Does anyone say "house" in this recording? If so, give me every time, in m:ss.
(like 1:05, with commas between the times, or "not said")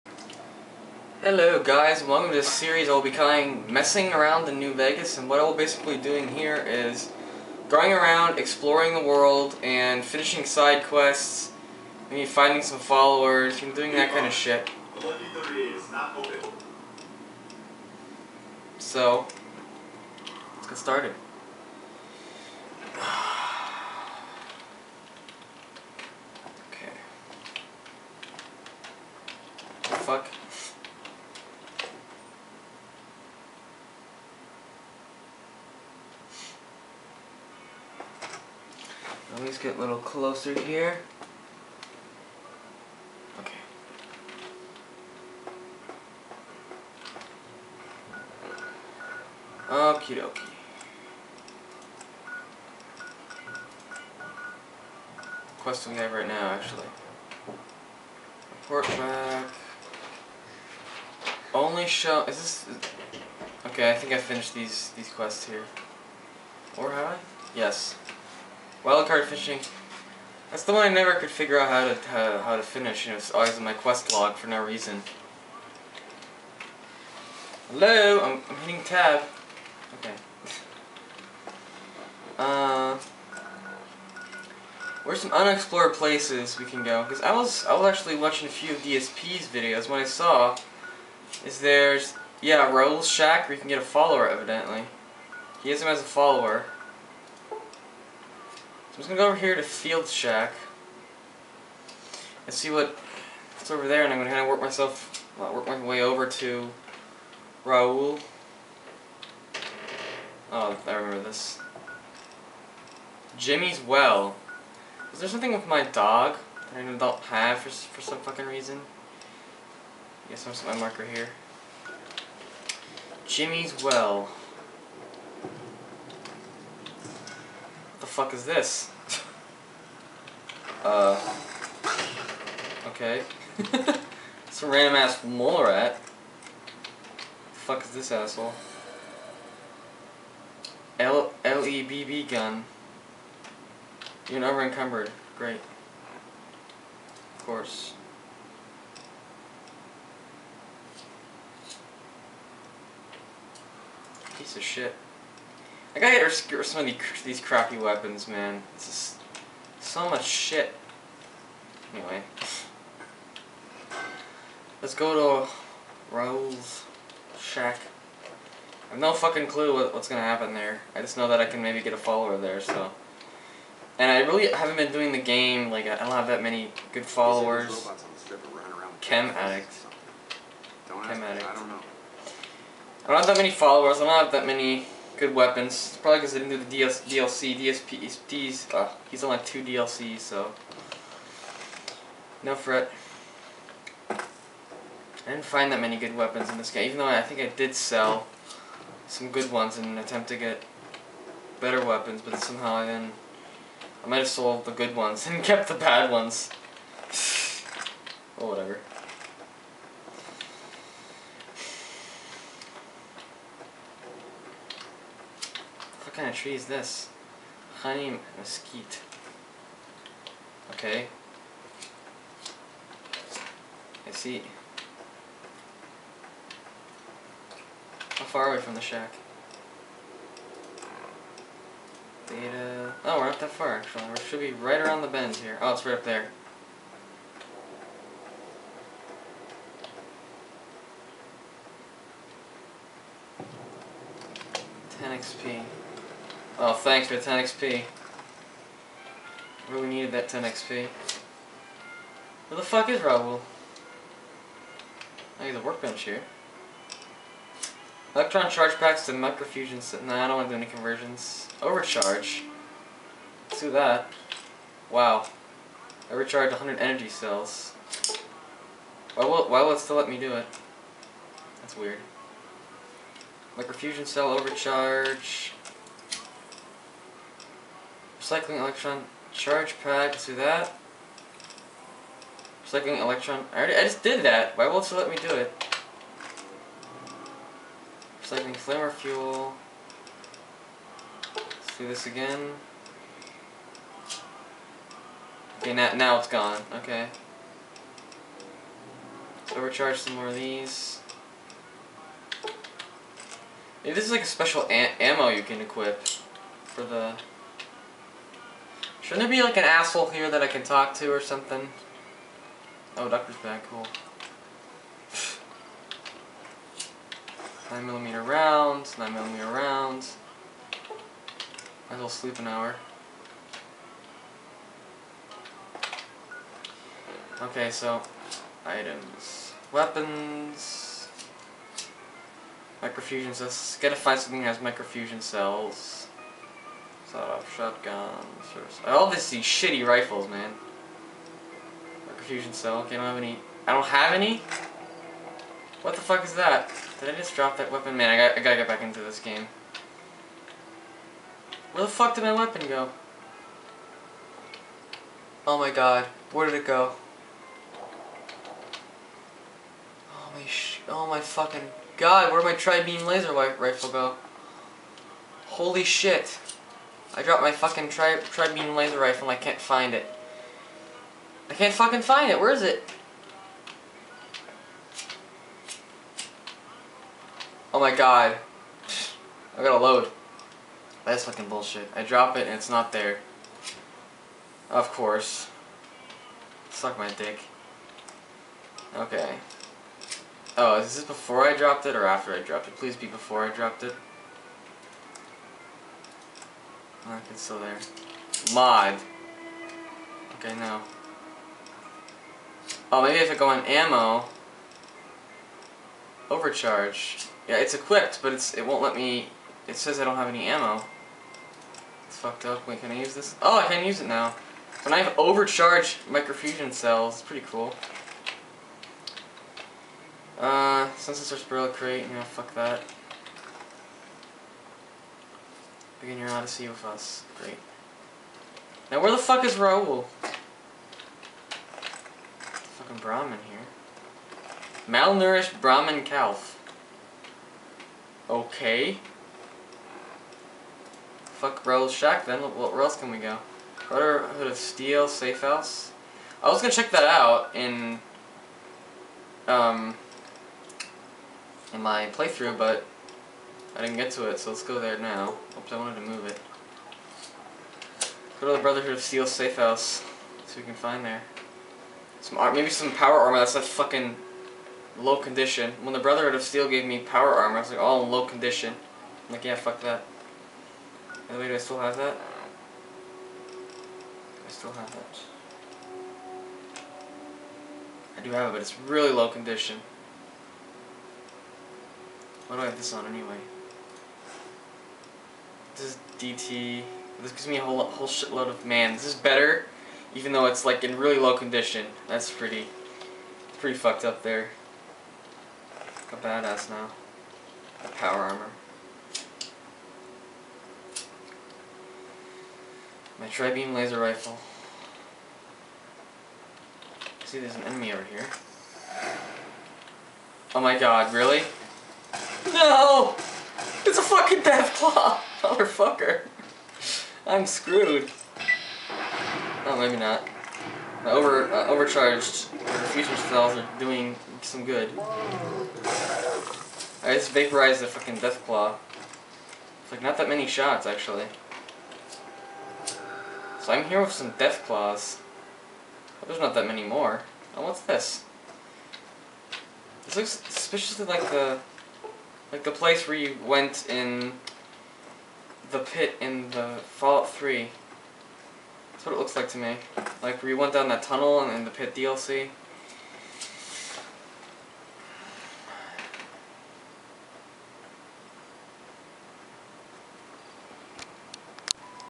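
7:25, 7:39.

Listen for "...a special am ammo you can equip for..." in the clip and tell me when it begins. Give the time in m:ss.
5:04.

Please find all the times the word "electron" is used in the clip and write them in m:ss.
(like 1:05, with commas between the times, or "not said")
4:18, 4:38, 4:42.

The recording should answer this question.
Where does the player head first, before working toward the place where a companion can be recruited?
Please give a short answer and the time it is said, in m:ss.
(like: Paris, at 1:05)
Field Shack, at 1:39.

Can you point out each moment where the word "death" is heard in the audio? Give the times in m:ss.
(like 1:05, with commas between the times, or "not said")
8:34, 8:48, 8:54.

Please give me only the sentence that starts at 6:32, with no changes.
Please be before I dropped it.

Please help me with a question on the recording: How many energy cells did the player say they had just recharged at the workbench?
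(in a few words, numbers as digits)
100.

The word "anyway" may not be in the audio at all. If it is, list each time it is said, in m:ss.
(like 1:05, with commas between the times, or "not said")
2:41, 8:03.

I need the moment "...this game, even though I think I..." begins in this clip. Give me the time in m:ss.
3:16.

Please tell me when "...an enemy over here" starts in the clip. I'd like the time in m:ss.
8:27.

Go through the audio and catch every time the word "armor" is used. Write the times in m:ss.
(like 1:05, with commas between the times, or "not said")
7:43, 7:47, 8:18.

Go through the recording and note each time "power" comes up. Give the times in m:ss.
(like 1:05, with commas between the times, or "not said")
7:42, 7:46, 8:17.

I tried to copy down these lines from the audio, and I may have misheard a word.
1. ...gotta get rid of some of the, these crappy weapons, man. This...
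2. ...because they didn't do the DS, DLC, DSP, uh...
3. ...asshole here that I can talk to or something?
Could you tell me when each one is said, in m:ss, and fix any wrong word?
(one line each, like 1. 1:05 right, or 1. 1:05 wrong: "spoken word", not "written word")
1. 2:35 right
2. 3:06 right
3. 5:09 right.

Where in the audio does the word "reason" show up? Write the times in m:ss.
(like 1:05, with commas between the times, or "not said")
1:14, 1:58.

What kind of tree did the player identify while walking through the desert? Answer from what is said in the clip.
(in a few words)
Honey mesquite.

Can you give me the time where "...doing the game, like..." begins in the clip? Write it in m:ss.
2:54.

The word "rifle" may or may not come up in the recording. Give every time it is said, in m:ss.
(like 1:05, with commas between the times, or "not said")
5:39, 6:03, 6:08, 8:23.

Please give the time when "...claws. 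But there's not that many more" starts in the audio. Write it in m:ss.
8:54.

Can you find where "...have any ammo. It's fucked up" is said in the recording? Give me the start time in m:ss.
6:50.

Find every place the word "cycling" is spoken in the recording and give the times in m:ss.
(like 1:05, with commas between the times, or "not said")
4:38, 4:42, 4:48.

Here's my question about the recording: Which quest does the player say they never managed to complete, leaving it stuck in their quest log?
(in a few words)
Wildcard fishing.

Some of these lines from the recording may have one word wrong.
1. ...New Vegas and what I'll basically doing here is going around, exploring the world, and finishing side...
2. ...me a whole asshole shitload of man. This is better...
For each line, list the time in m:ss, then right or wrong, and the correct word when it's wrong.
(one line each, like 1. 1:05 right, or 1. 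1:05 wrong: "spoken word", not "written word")
1. 0:04 right
2. 8:07 wrong: "whole", not "asshole".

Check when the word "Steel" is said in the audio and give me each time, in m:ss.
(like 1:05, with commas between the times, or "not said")
7:24, 7:39, 7:46.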